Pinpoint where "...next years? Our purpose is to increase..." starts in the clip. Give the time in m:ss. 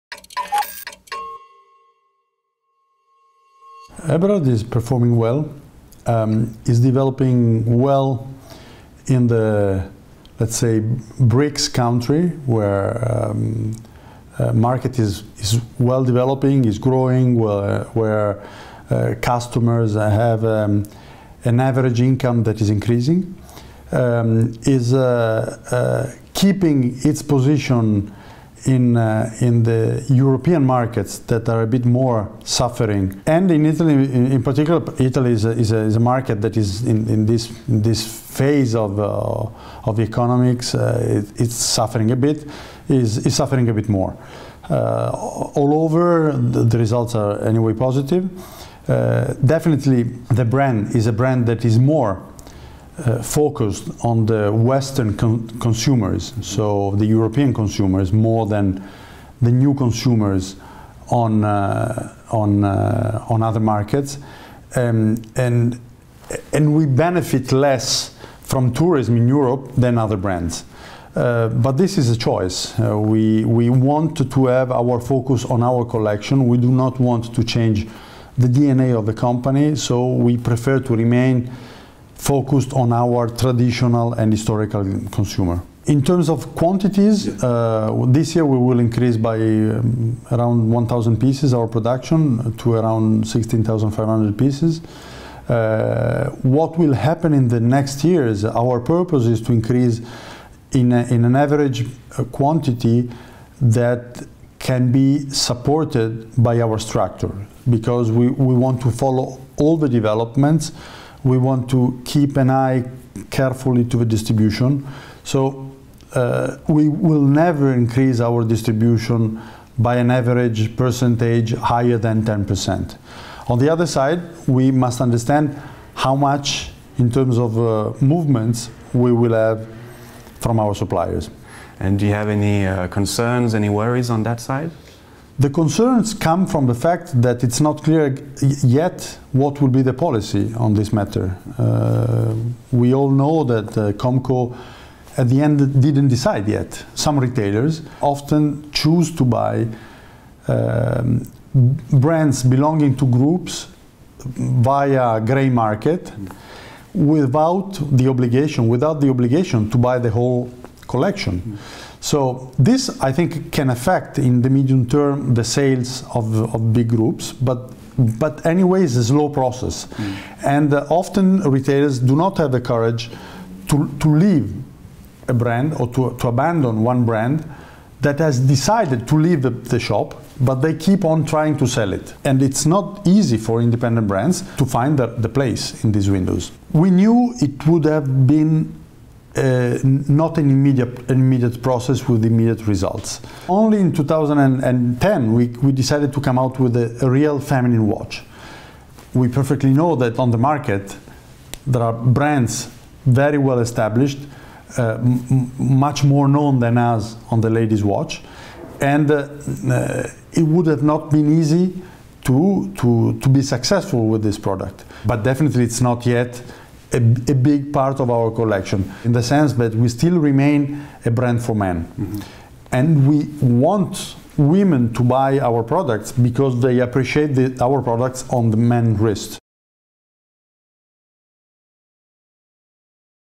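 1:37.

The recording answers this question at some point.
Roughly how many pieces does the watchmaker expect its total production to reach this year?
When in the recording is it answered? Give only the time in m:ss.
1:33.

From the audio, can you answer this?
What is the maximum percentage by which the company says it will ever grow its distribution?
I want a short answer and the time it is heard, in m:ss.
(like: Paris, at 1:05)
10%, at 2:02.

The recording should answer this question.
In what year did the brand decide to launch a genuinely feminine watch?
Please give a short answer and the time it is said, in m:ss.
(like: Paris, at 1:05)
2010, at 3:13.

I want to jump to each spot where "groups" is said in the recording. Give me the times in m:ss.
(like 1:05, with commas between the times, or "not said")
2:33, 2:46.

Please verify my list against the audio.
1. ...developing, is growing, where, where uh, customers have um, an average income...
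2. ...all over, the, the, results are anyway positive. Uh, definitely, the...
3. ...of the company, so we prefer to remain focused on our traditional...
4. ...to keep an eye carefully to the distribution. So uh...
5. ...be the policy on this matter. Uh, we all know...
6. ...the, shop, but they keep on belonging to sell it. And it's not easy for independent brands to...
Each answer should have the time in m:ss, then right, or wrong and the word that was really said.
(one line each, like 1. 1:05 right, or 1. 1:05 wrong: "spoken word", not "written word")
1. 0:16 right
2. 0:45 right
3. 1:18 right
4. 1:51 right
5. 2:19 right
6. 2:59 wrong: "trying", not "belonging".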